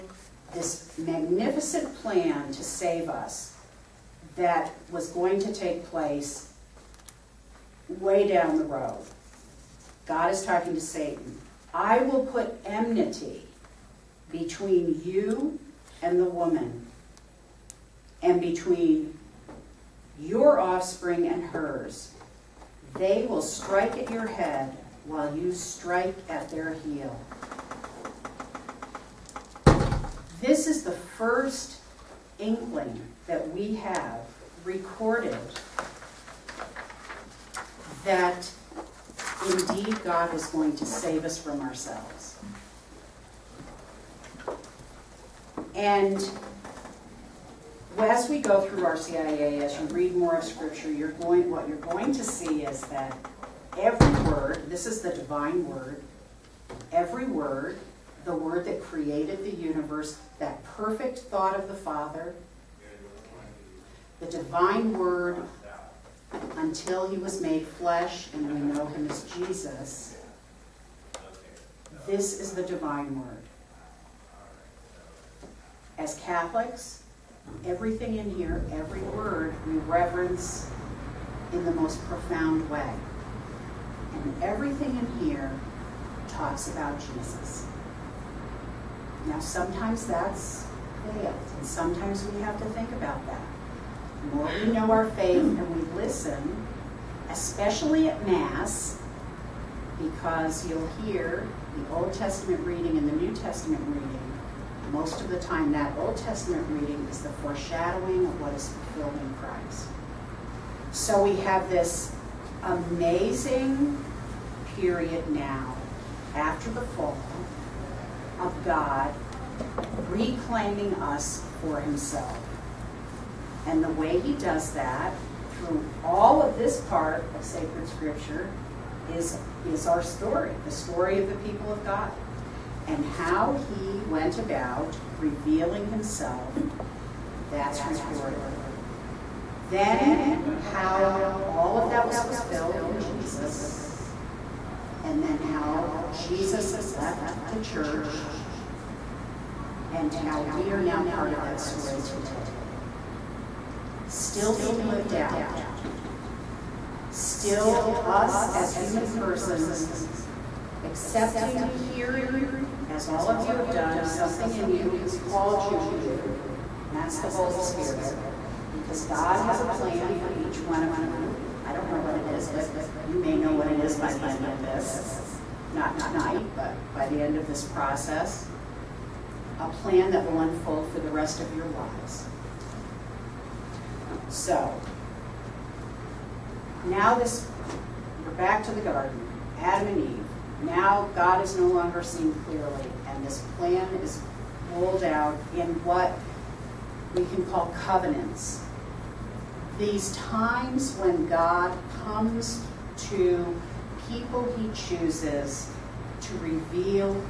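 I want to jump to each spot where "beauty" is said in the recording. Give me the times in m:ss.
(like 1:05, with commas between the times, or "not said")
not said.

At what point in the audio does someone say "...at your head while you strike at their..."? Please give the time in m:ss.
0:23.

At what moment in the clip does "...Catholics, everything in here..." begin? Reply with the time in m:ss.
1:16.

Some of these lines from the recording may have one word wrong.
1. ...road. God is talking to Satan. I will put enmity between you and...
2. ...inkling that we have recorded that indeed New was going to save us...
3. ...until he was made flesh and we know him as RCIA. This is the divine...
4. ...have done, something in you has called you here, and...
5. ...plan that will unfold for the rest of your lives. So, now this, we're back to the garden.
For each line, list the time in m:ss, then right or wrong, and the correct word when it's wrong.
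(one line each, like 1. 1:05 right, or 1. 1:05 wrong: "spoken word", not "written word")
1. 0:08 right
2. 0:32 wrong: "God", not "New"
3. 1:06 wrong: "Jesus", not "RCIA"
4. 2:43 right
5. 2:59 right.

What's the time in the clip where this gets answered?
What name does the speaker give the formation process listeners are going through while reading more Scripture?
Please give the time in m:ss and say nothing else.
0:48.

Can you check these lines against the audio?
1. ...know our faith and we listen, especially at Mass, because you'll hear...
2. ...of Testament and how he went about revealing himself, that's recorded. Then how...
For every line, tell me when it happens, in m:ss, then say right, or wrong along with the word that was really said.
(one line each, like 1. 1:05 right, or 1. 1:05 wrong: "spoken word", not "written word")
1. 1:34 right
2. 2:11 wrong: "God", not "Testament".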